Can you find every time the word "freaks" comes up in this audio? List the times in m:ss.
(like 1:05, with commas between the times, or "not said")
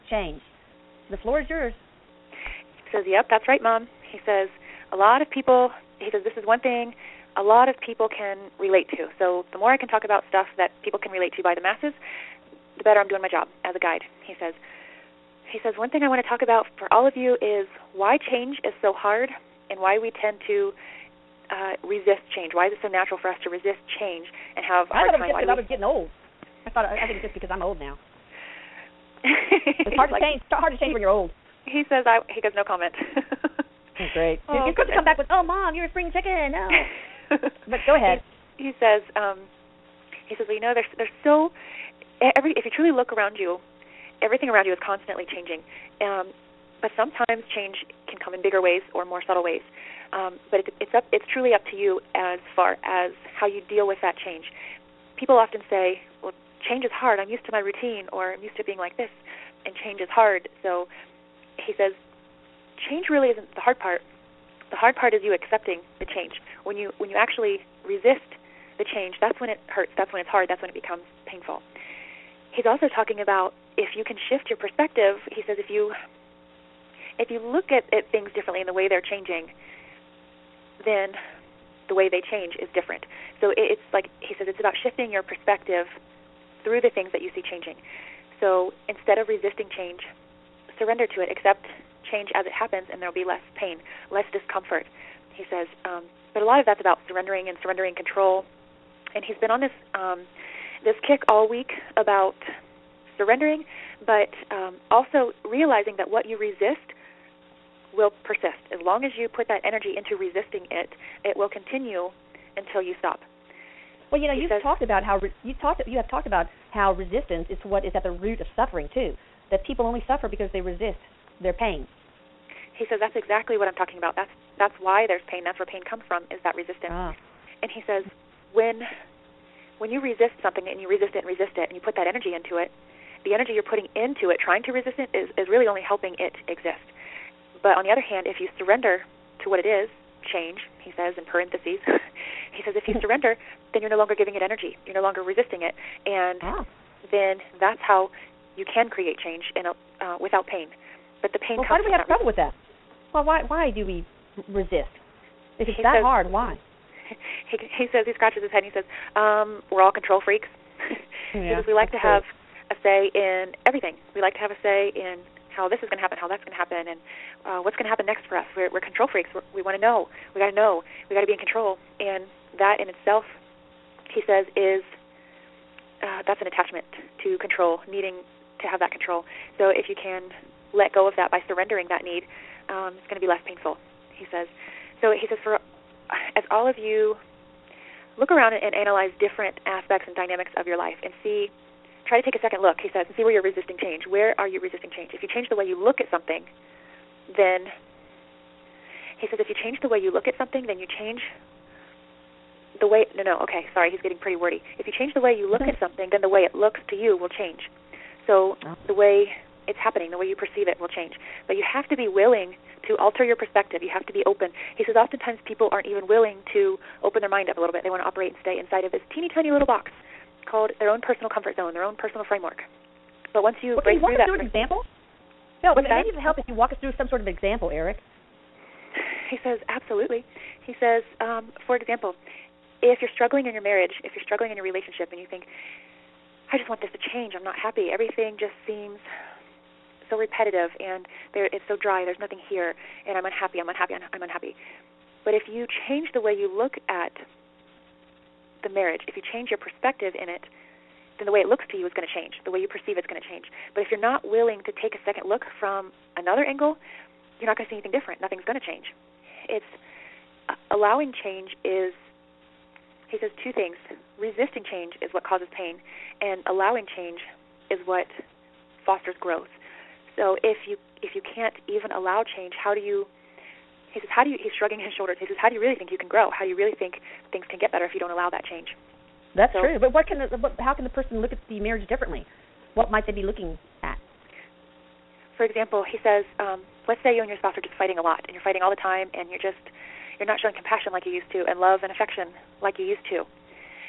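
2:40, 2:49.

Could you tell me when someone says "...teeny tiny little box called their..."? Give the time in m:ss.
3:39.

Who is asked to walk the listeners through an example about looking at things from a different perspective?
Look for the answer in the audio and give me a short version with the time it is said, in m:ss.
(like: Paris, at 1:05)
Erik, at 3:47.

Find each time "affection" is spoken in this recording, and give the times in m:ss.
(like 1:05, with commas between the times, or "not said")
4:51.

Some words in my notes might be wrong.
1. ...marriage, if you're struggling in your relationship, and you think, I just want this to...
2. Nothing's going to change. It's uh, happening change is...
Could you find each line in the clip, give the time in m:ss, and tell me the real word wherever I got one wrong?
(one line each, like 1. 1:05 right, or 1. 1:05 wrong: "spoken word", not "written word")
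1. 3:53 right
2. 4:18 wrong: "allowing", not "happening".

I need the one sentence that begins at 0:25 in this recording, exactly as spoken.
I thought it was just because I was getting old.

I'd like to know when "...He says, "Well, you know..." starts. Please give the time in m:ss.
0:40.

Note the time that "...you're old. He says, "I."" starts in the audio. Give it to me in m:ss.
0:30.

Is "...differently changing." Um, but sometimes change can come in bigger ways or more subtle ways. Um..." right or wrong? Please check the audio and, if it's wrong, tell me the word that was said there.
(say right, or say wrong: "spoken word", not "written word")
wrong: "constantly", not "differently".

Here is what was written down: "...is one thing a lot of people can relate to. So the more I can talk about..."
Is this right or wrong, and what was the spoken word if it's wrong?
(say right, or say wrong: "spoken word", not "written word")
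right.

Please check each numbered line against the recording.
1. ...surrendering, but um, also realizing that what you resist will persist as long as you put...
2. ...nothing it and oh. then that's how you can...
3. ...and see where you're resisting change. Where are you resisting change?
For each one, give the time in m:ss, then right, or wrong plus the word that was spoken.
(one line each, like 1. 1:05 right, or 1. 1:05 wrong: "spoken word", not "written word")
1. 1:43 right
2. 2:25 wrong: "resisting", not "nothing"
3. 3:13 right.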